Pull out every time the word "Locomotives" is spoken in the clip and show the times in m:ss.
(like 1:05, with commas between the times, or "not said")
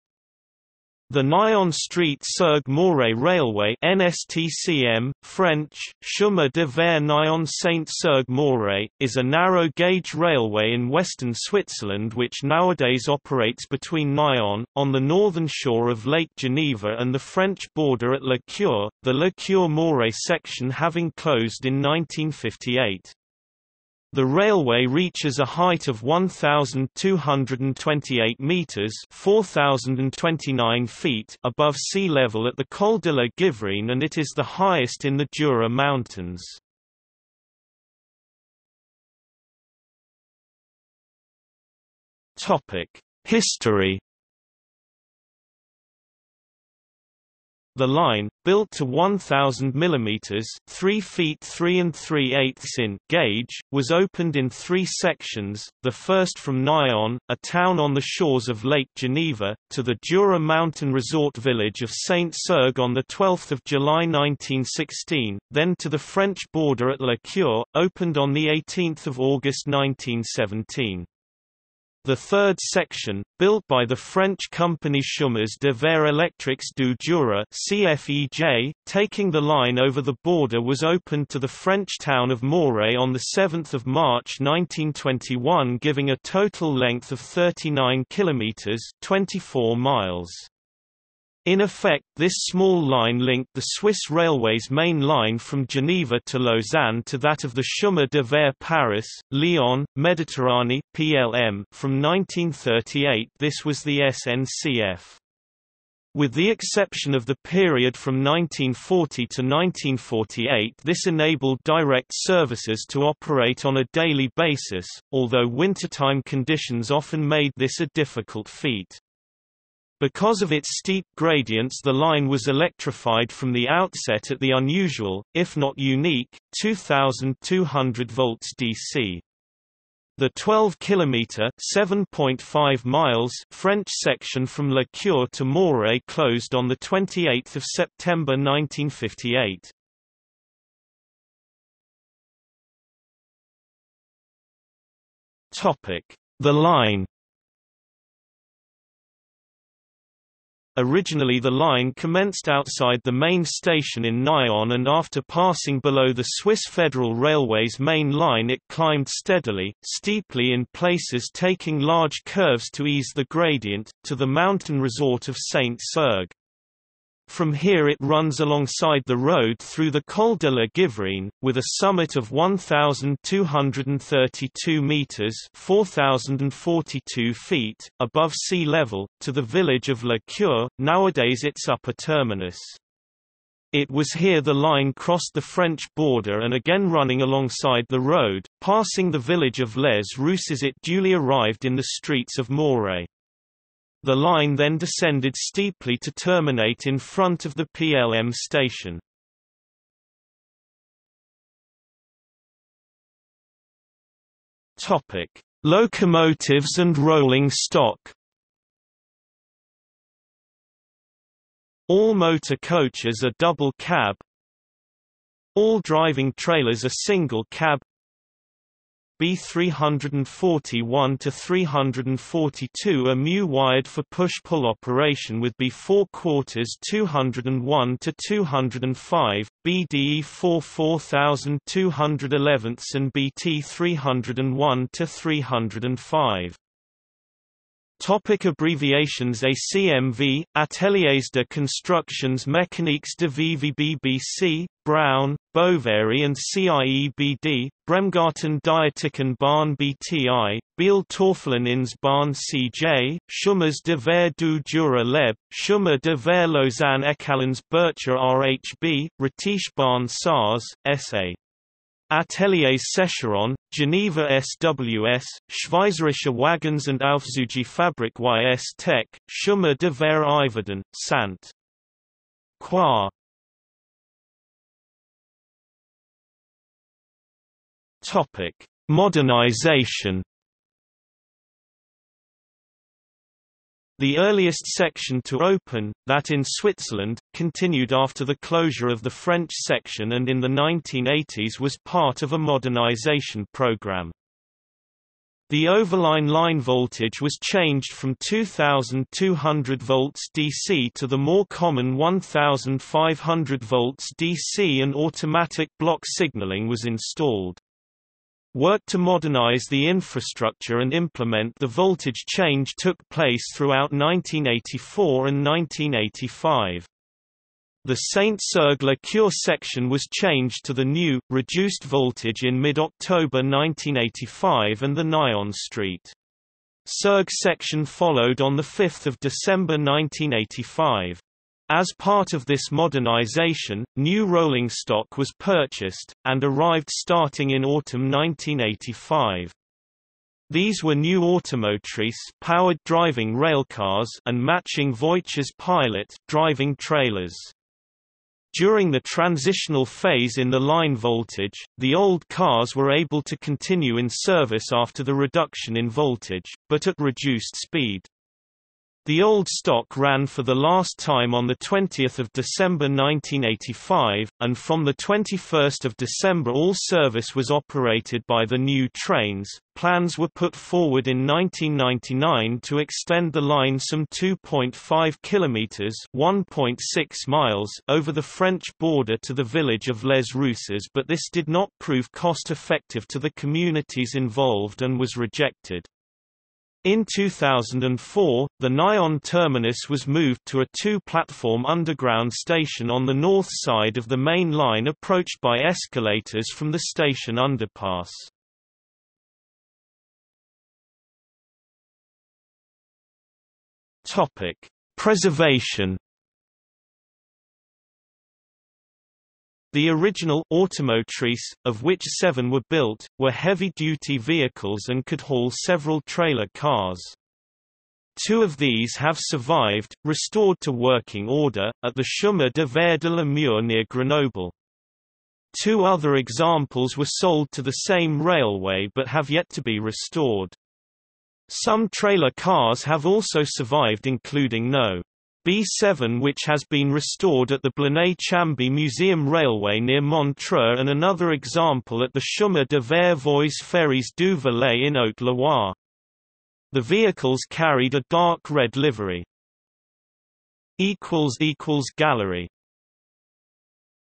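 3:25.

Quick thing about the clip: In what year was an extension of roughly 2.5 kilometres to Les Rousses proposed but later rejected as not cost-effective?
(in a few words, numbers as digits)
1999.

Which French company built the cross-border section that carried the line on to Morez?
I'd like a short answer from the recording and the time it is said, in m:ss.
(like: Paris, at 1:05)
Chemins de fer Électriques du Jura, at 1:15.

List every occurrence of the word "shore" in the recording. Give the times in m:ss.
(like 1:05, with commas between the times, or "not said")
0:15, 0:58.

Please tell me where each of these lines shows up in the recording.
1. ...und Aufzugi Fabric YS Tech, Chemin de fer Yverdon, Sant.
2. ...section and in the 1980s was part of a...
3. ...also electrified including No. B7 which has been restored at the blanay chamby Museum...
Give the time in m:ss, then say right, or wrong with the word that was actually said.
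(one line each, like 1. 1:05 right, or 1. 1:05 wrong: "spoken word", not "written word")
1. 4:26 right
2. 4:49 right
3. 7:13 wrong: "survived", not "electrified".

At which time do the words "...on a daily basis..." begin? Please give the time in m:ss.
1:53.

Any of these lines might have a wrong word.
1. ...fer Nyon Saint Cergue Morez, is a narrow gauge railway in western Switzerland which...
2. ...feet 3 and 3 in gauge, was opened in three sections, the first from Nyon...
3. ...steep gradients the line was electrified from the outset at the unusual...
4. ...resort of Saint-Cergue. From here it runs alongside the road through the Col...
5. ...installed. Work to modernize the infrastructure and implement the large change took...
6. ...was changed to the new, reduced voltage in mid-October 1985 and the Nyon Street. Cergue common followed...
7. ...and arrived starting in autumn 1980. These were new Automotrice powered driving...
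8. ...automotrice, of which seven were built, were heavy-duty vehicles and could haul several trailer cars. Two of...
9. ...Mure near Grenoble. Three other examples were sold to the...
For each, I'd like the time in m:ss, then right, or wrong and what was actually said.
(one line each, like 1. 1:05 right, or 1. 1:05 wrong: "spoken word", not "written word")
1. 0:06 right
2. 0:50 right
3. 2:00 right
4. 2:44 right
5. 5:06 wrong: "voltage", not "large"
6. 5:19 wrong: "section", not "common"
7. 5:36 wrong: "1985", not "1980"
8. 6:50 right
9. 7:03 wrong: "Two", not "Three".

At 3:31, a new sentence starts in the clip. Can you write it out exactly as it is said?
All motor coaches are double cab.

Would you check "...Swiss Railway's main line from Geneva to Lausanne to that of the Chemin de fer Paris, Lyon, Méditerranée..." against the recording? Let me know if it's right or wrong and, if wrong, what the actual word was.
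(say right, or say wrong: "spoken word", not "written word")
right.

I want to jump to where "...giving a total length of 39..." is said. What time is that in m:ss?
1:25.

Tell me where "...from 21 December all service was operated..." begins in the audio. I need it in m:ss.
6:04.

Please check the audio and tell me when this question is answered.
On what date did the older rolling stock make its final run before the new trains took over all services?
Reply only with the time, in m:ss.
6:01.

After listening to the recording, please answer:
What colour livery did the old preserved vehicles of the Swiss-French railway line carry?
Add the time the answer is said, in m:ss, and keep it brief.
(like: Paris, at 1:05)
Dark red, at 7:28.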